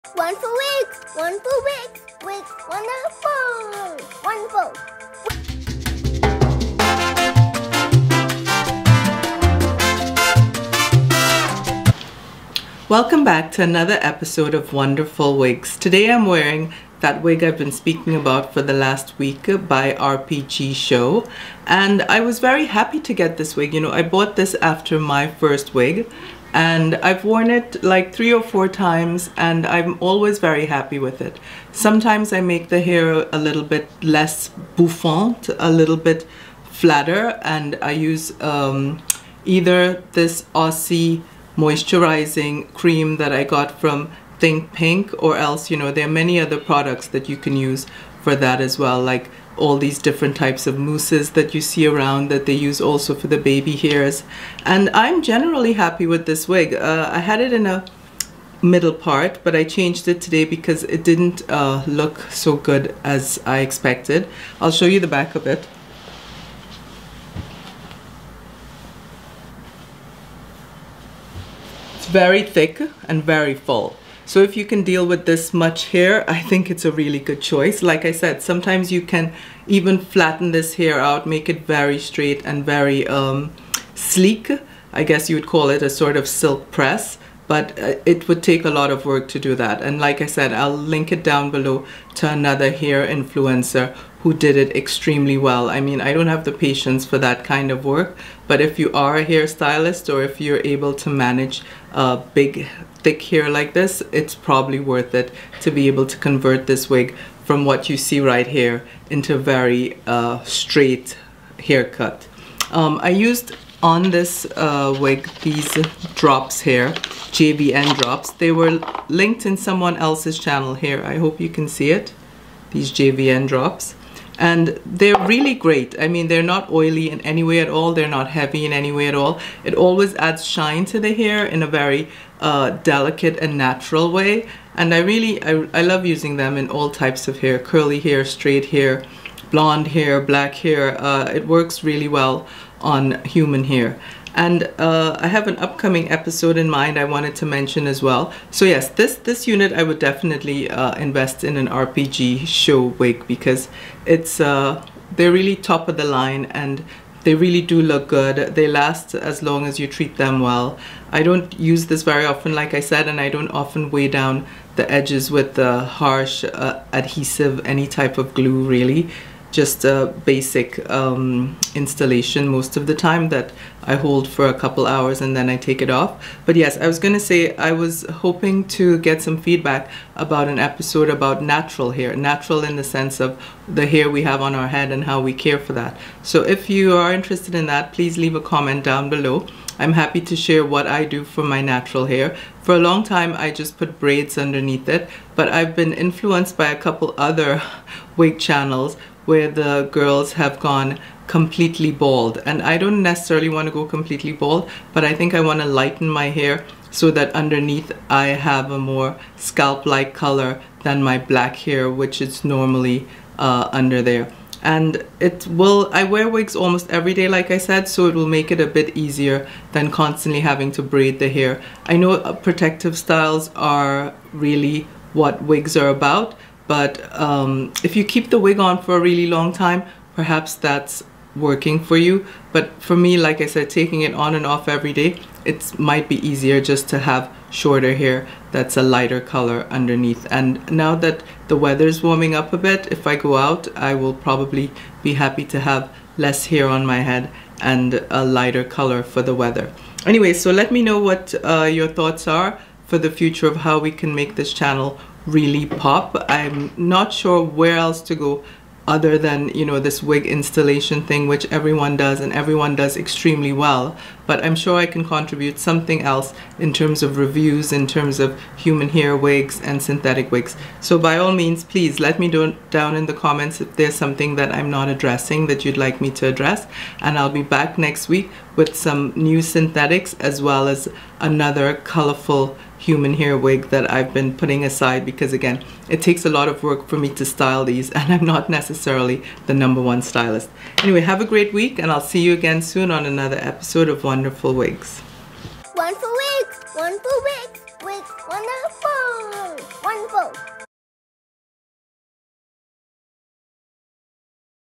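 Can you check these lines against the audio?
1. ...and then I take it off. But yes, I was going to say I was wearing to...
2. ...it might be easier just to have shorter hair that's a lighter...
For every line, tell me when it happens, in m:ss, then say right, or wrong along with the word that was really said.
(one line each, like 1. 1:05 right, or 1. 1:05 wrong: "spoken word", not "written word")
1. 2:55 wrong: "hoping", not "wearing"
2. 3:55 right.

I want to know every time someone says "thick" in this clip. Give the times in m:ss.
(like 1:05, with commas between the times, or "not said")
1:12, 1:43.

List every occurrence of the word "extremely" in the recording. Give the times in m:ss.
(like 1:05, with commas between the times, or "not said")
1:34, 4:22.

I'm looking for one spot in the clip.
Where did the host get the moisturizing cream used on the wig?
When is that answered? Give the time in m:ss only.
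0:44.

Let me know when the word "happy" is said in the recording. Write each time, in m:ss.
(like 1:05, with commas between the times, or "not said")
0:22, 0:30, 0:55, 3:09, 4:05.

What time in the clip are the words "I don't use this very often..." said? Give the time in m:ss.
2:41.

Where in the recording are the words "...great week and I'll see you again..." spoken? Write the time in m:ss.
4:51.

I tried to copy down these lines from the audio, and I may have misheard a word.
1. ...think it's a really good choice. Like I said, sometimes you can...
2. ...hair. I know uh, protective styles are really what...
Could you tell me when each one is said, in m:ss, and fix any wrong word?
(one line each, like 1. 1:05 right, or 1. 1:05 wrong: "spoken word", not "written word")
1. 1:16 right
2. 3:41 right.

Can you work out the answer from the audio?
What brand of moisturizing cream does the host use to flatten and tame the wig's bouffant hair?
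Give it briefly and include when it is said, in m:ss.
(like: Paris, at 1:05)
Aussie, at 0:40.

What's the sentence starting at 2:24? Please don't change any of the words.
And uh, I have an upcoming episode in mind I wanted to mention as well.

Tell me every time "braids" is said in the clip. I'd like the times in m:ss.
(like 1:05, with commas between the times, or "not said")
3:13, 3:40.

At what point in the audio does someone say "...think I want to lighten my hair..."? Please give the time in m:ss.
3:25.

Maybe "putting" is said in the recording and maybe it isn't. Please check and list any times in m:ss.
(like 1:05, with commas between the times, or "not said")
4:44.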